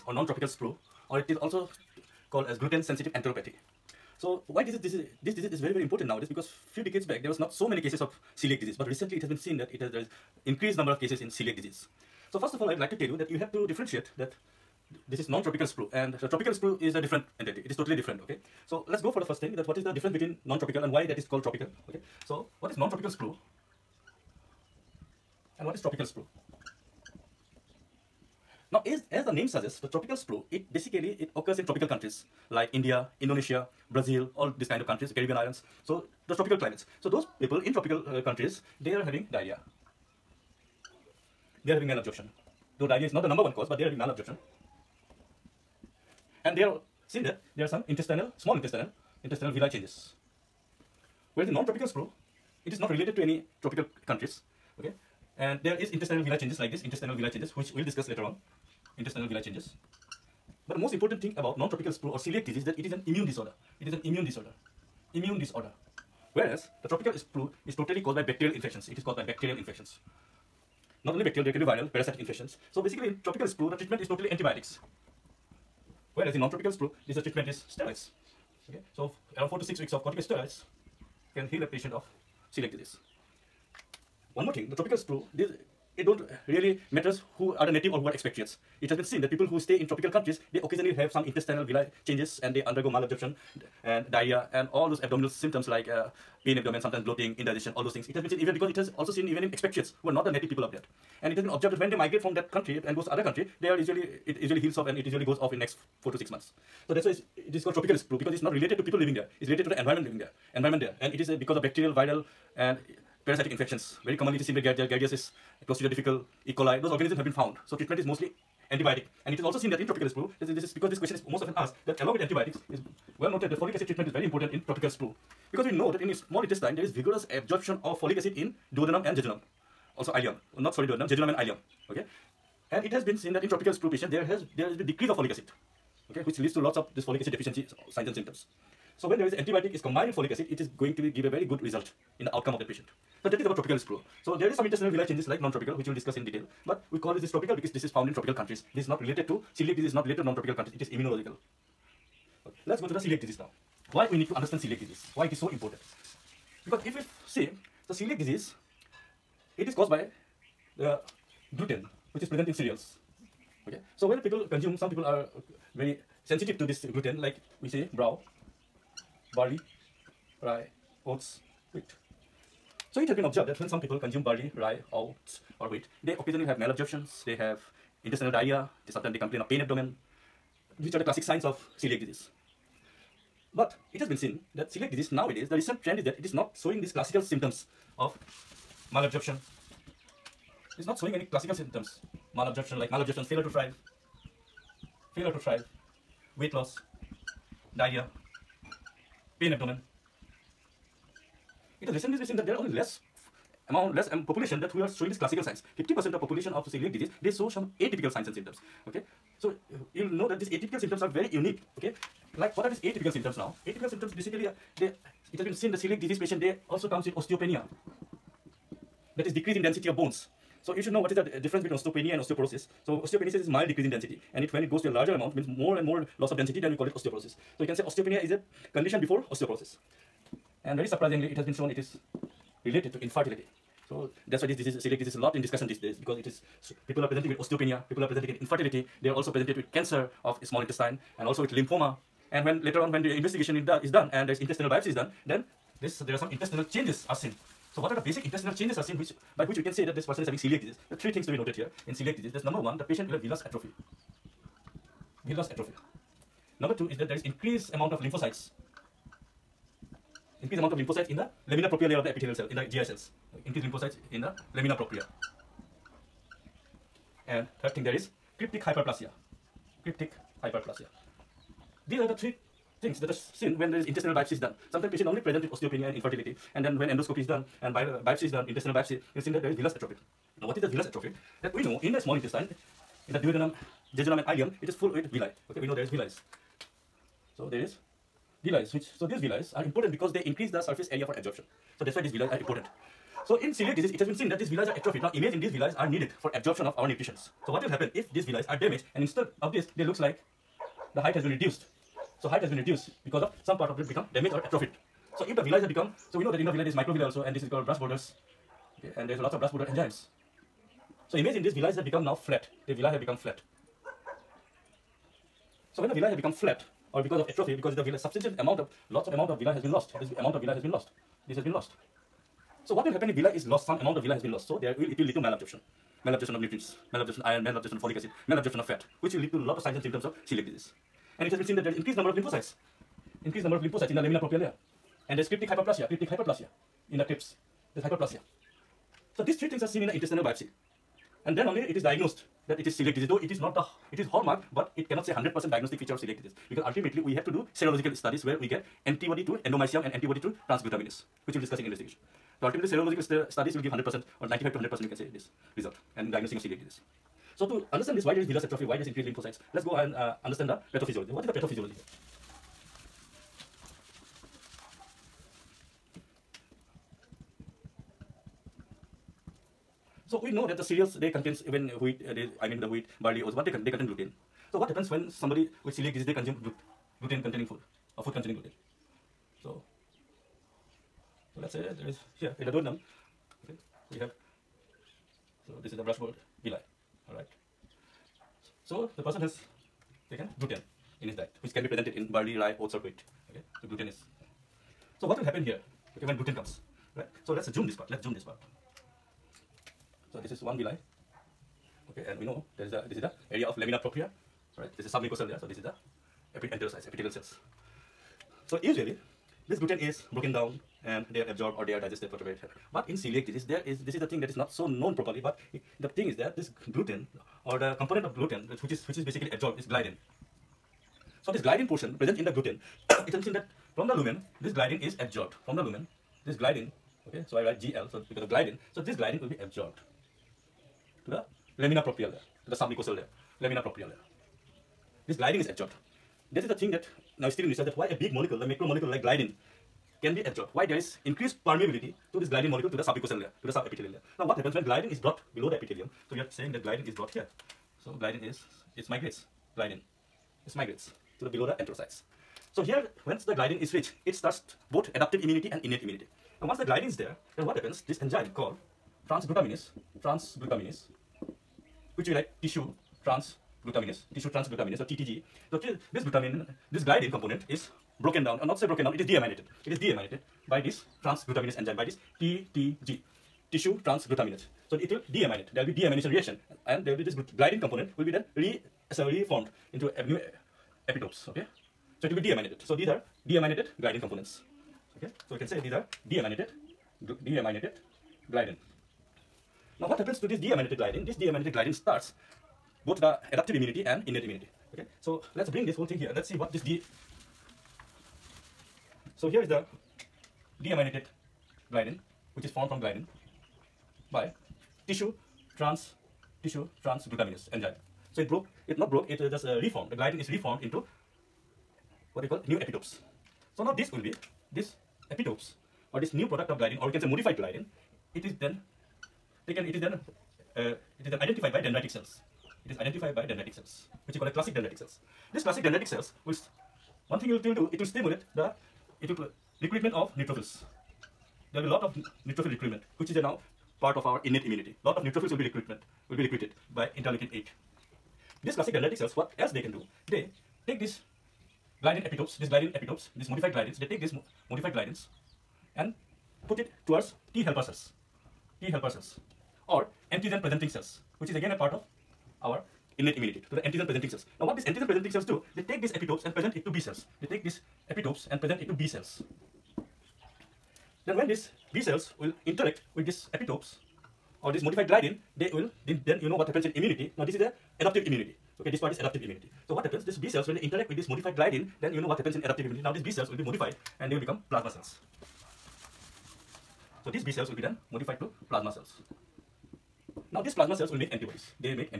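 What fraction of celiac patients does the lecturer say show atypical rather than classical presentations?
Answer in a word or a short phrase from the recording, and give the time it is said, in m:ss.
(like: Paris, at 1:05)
50%, at 3:25.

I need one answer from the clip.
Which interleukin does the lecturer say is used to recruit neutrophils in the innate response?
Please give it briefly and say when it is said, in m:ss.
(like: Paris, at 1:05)
Interleukin 8, at 8:56.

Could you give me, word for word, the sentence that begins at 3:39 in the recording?
That is decrease in density of bones so you should know what is the uh, difference between osteopenia and osteoporosis.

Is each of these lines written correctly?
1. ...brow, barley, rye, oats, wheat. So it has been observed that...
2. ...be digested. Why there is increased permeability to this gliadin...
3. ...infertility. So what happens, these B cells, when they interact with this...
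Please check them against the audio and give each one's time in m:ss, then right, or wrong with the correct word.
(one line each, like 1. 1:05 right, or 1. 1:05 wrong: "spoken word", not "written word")
1. 2:47 right
2. 7:20 wrong: "absorbed", not "digested"
3. 9:29 wrong: "immunity", not "infertility".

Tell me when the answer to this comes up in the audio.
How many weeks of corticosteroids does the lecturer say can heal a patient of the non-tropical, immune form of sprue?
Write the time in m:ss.
1:19.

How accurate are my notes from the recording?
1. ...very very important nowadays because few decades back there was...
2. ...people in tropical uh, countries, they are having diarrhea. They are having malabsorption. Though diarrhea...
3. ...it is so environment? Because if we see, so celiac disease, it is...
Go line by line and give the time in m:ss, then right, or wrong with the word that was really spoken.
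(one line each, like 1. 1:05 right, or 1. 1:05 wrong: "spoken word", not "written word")
1. 0:05 right
2. 0:37 right
3. 2:35 wrong: "important", not "environment".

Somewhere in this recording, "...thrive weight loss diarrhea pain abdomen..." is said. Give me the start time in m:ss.
3:15.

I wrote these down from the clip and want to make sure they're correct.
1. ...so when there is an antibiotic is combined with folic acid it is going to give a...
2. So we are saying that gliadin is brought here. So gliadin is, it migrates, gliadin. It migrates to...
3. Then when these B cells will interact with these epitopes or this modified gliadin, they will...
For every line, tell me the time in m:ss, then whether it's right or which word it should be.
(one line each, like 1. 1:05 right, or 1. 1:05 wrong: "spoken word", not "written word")
1. 2:18 right
2. 7:26 right
3. 9:21 right.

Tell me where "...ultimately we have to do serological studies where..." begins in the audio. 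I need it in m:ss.
5:46.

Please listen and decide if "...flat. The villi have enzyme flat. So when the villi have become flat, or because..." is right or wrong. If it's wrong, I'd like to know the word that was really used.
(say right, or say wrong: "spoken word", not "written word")
wrong: "become", not "enzyme".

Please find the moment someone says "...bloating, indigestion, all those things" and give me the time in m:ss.
1:37.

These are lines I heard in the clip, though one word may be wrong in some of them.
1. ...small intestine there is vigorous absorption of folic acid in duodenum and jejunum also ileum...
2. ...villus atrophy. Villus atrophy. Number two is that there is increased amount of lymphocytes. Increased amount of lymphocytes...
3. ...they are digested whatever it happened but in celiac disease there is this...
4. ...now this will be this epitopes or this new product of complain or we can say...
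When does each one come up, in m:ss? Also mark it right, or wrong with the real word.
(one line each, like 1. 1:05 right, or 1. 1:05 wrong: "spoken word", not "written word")
1. 2:06 right
2. 4:13 right
3. 6:51 right
4. 8:33 wrong: "gliadin", not "complain".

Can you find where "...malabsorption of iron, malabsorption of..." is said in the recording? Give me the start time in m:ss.
5:26.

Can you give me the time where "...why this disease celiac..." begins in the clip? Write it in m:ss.
3:54.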